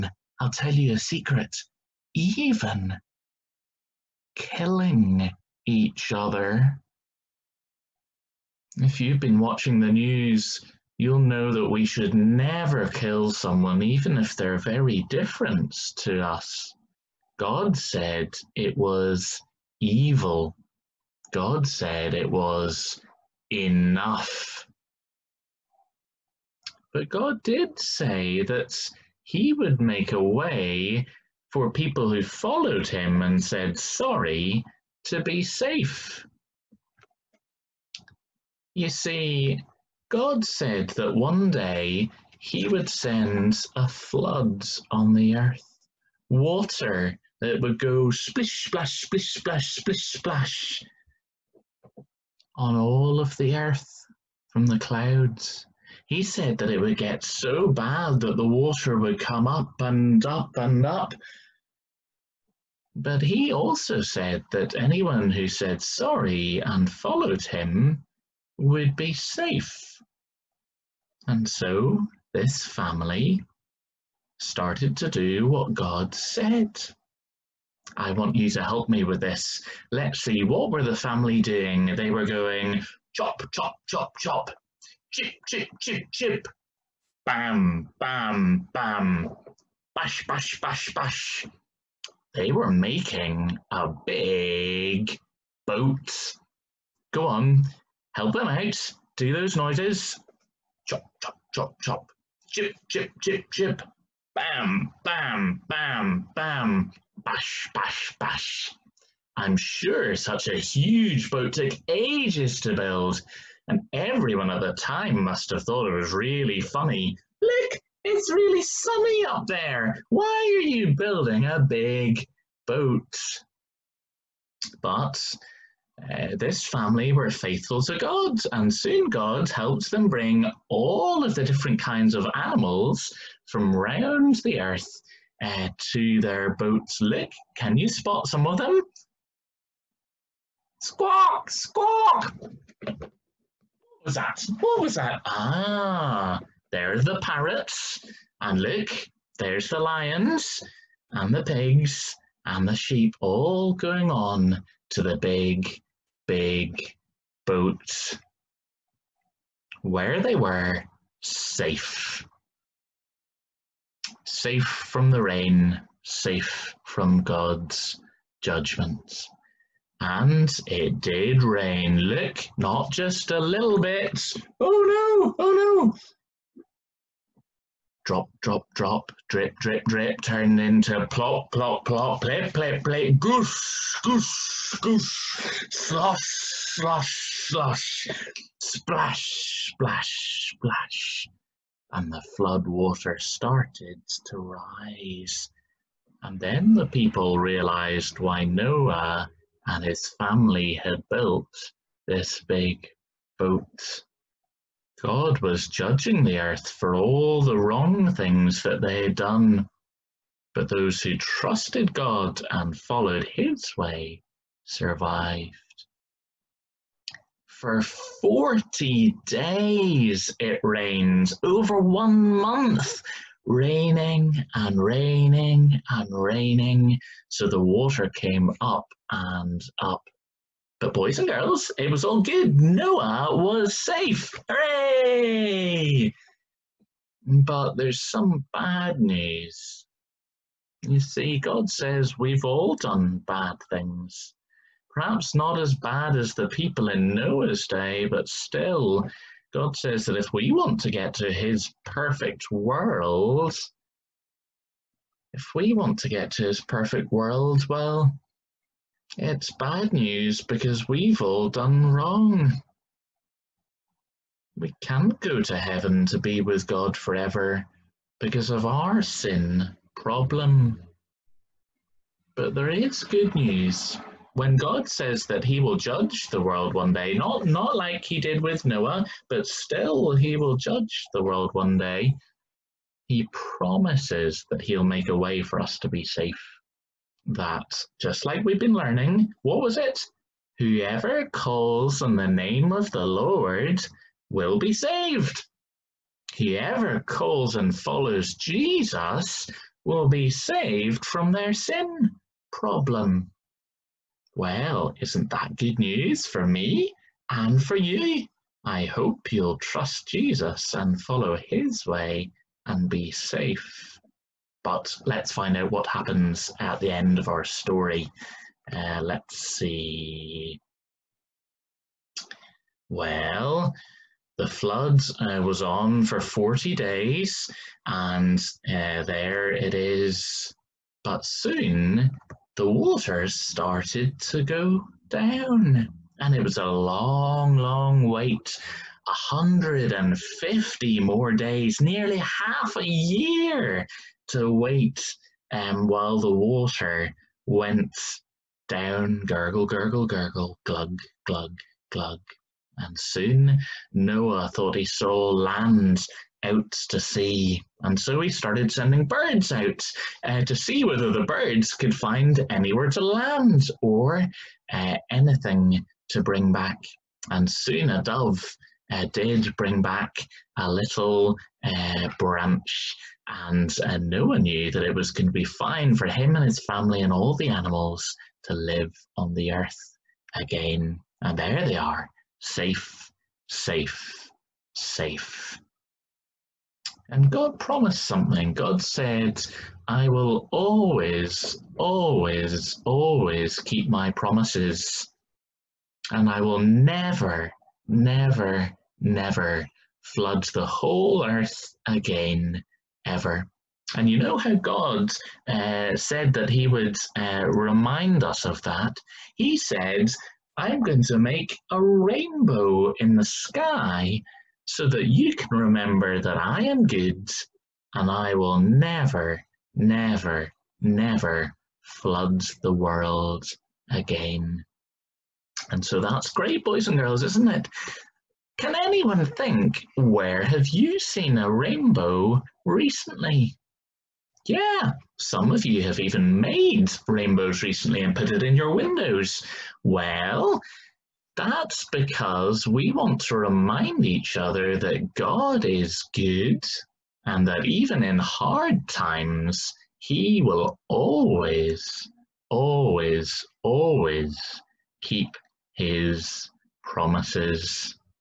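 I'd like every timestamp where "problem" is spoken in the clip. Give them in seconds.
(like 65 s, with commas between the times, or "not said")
269 s, 302 s.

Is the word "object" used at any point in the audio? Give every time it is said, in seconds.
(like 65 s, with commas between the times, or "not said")
not said.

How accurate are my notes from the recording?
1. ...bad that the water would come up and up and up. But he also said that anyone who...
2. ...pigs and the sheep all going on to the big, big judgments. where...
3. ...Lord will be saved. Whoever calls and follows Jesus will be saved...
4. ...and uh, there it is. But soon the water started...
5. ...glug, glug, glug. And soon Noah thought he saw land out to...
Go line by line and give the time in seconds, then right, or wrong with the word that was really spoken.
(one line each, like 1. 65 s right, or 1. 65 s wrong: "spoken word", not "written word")
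1. 57 s right
2. 151 s wrong: "boats", not "judgments"
3. 293 s right
4. 327 s right
5. 350 s right.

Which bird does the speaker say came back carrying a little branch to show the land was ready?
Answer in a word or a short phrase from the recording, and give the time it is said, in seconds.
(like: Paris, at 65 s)
A dove, at 367 s.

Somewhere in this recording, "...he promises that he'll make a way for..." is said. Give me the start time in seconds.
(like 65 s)
283 s.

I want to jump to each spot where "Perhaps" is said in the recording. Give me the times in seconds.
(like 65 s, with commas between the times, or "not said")
244 s.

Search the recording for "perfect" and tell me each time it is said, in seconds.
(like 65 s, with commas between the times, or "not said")
251 s, 256 s.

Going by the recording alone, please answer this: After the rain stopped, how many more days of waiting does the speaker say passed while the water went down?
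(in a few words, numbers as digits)
150.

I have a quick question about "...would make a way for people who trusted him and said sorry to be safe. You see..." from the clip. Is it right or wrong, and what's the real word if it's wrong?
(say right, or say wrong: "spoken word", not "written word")
wrong: "followed", not "trusted".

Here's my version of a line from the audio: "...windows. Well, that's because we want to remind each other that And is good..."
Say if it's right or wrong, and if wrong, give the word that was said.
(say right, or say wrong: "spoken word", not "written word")
wrong: "God", not "And".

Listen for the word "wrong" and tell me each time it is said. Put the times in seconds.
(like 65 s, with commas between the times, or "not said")
207 s, 261 s.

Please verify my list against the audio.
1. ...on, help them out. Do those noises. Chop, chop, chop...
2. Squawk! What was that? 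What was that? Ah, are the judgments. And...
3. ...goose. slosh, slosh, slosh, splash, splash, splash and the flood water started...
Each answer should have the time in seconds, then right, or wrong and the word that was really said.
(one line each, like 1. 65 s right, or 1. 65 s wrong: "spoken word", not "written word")
1. 97 s right
2. 141 s wrong: "parrots", not "judgments"
3. 184 s right.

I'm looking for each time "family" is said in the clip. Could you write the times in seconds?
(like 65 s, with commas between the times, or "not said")
72 s, 80 s, 126 s, 200 s, 376 s.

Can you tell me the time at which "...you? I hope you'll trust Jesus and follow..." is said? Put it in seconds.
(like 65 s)
307 s.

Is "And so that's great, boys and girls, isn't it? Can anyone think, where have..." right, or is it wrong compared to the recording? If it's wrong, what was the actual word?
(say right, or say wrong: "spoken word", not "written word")
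right.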